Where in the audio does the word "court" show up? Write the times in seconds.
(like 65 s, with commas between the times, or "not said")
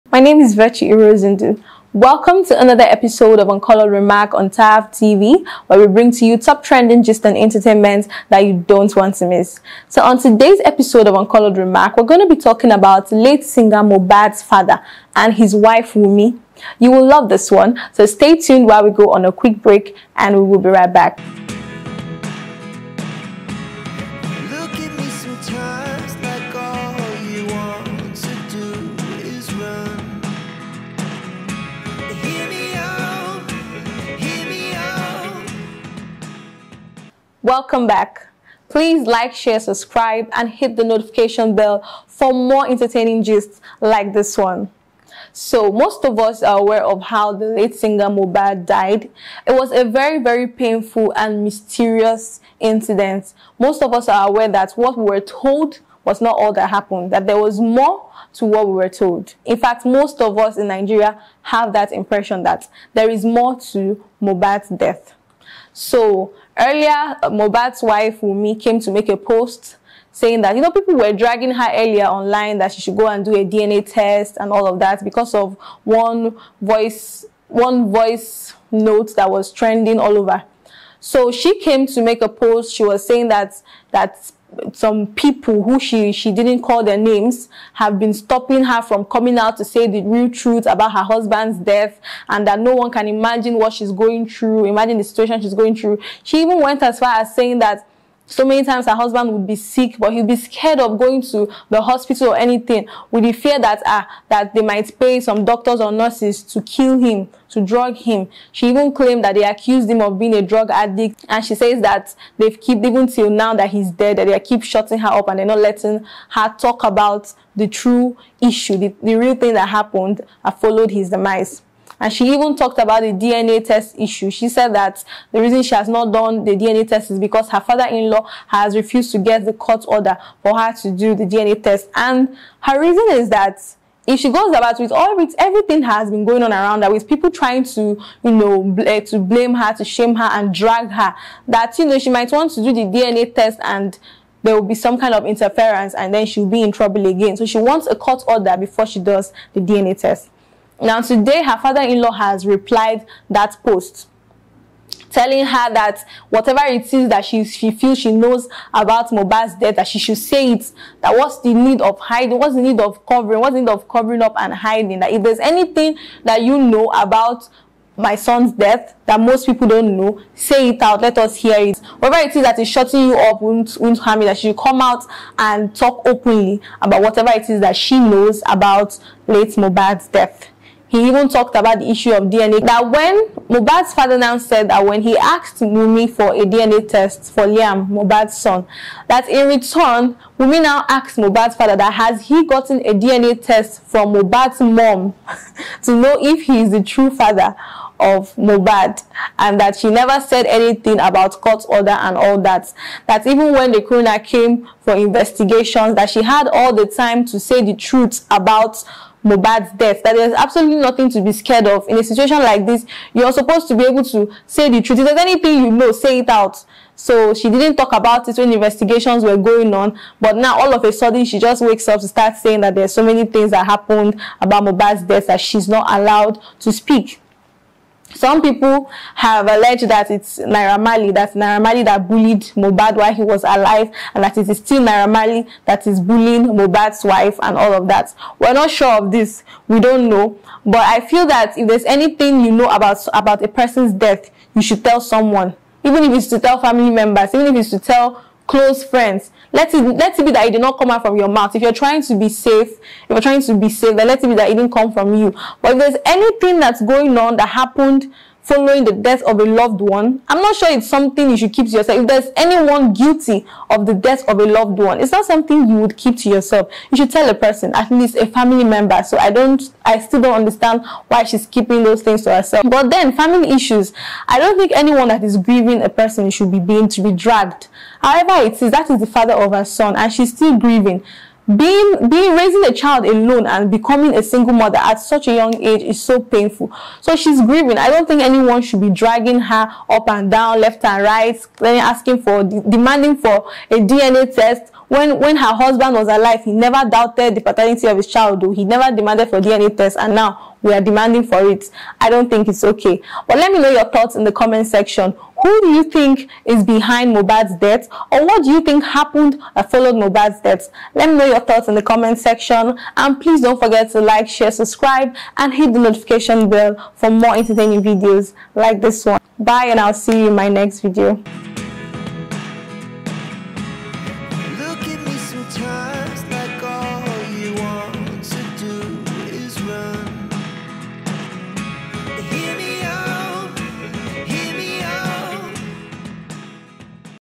129 s, 147 s, 201 s.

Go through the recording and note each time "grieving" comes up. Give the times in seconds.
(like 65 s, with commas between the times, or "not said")
275 s, 280 s, 287 s.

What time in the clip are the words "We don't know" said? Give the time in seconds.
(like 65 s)
239 s.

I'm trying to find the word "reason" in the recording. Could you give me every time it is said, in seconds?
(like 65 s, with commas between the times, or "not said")
125 s, 132 s.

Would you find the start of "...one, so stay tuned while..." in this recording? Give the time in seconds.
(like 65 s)
17 s.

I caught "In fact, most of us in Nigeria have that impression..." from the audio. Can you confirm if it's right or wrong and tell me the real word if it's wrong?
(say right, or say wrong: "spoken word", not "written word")
right.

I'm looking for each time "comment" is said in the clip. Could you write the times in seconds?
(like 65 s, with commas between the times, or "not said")
304 s, 311 s.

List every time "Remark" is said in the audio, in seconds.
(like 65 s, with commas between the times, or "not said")
3 s, 11 s.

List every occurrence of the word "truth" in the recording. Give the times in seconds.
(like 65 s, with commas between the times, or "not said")
90 s, 207 s, 214 s.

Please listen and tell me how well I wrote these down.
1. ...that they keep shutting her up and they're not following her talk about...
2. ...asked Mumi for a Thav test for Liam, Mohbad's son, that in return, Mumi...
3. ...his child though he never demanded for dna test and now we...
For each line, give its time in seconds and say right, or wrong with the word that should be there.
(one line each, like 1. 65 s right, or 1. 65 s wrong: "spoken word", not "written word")
1. 114 s wrong: "letting", not "following"
2. 185 s wrong: "DNA", not "Thav"
3. 297 s right.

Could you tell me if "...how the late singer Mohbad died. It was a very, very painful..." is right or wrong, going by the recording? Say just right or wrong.
right.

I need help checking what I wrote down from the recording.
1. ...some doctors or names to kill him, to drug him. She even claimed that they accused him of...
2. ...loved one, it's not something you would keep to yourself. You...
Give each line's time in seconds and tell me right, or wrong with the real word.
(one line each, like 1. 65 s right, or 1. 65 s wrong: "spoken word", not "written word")
1. 105 s wrong: "nurses", not "names"
2. 264 s right.